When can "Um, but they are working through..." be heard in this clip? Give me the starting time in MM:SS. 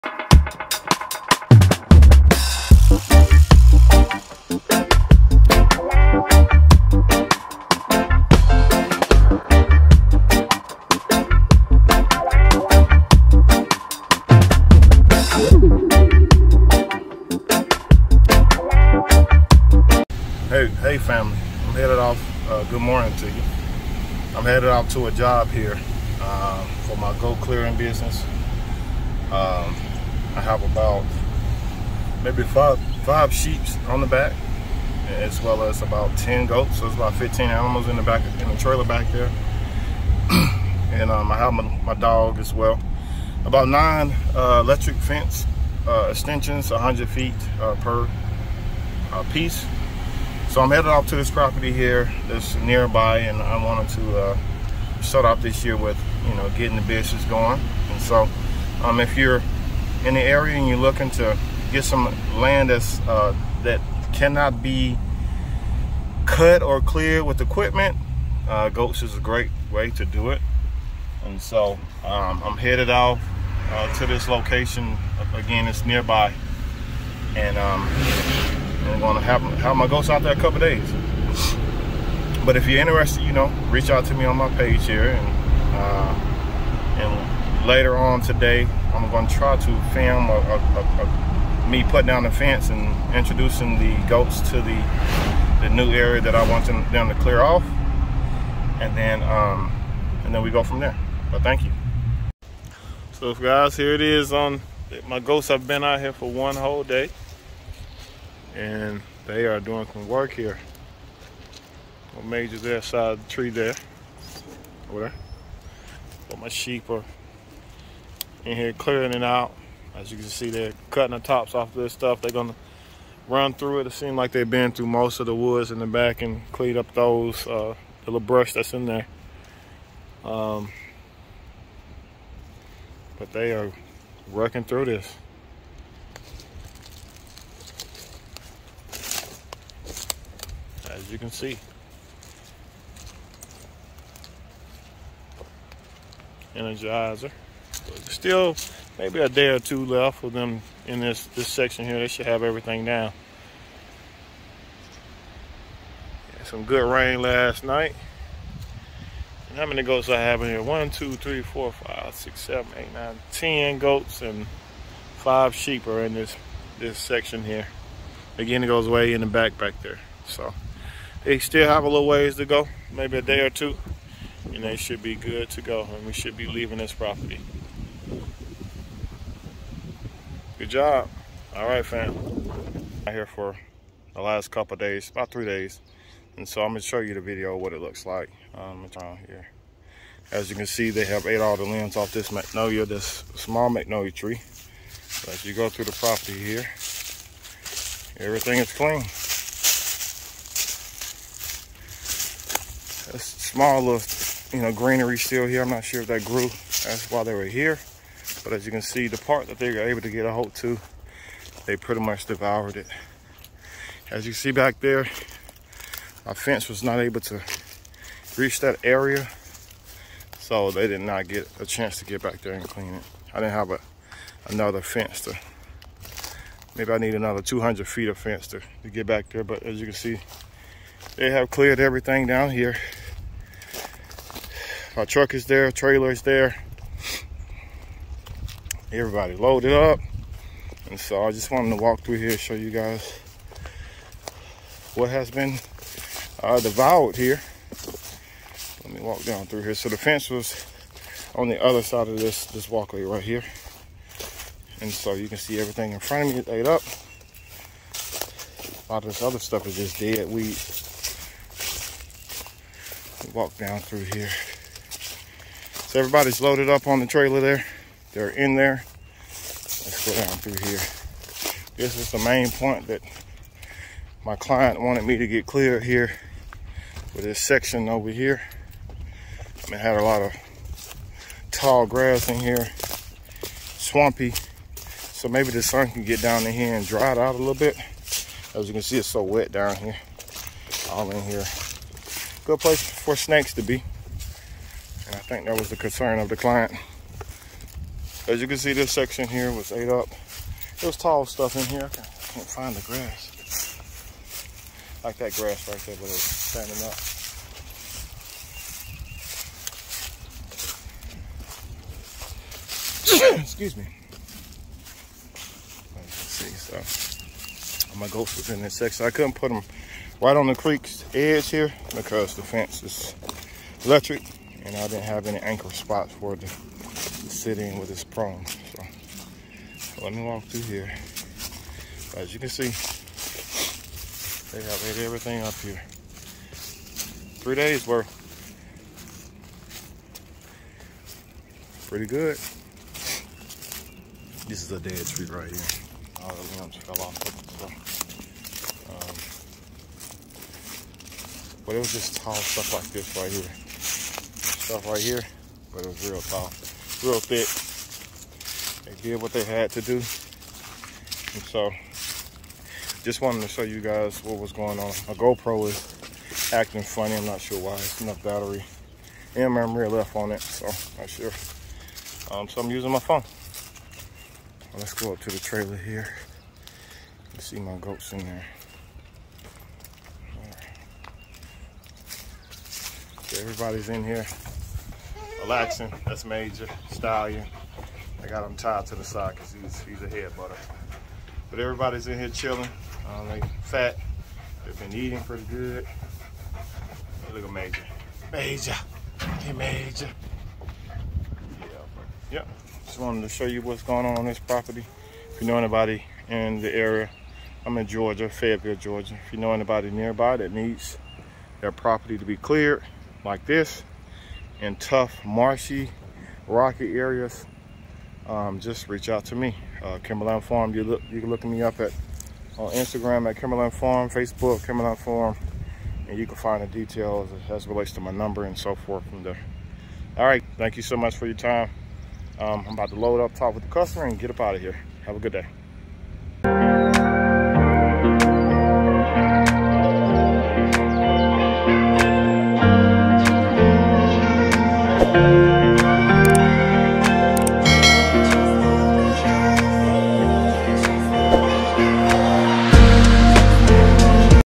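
02:10.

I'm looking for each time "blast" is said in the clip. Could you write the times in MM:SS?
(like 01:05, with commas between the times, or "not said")
not said.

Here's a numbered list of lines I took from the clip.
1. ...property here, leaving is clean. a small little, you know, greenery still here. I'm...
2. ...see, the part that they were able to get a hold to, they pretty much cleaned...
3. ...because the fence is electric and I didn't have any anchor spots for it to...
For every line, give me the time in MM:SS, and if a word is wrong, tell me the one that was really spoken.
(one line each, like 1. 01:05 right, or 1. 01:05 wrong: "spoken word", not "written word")
1. 03:15 wrong: "everything", not "leaving"
2. 03:28 wrong: "devoured", not "cleaned"
3. 05:21 right.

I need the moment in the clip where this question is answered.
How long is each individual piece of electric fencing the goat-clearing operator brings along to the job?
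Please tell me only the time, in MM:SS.
00:46.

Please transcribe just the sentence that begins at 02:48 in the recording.
Again, it goes way in the back back there.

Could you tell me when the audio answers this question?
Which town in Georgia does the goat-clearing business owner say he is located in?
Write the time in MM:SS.
06:48.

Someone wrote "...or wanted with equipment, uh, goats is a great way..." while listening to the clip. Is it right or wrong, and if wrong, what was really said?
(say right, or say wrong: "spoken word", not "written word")
wrong: "cleared", not "wanted".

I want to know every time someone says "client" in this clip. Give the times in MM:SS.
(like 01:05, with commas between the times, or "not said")
04:34, 04:56.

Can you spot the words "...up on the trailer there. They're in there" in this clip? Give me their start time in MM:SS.
04:26.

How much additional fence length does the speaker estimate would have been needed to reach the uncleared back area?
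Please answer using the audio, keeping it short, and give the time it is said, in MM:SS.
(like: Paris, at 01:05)
200 feet, at 03:47.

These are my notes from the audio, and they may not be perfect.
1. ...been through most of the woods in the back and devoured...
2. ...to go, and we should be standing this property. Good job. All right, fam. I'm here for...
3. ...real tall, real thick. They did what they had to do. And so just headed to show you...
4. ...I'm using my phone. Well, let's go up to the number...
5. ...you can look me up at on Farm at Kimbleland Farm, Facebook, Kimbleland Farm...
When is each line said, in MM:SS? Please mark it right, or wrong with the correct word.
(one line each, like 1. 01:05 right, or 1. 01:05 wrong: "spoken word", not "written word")
1. 02:04 wrong: "cleaned", not "devoured"
2. 02:55 wrong: "leaving", not "standing"
3. 05:56 wrong: "wanted", not "headed"
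4. 06:12 wrong: "trailer", not "number"
5. 07:01 wrong: "Instagram", not "Farm".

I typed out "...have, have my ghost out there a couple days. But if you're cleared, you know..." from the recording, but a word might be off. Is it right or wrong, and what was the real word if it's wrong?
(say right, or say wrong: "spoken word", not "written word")
wrong: "interested", not "cleared".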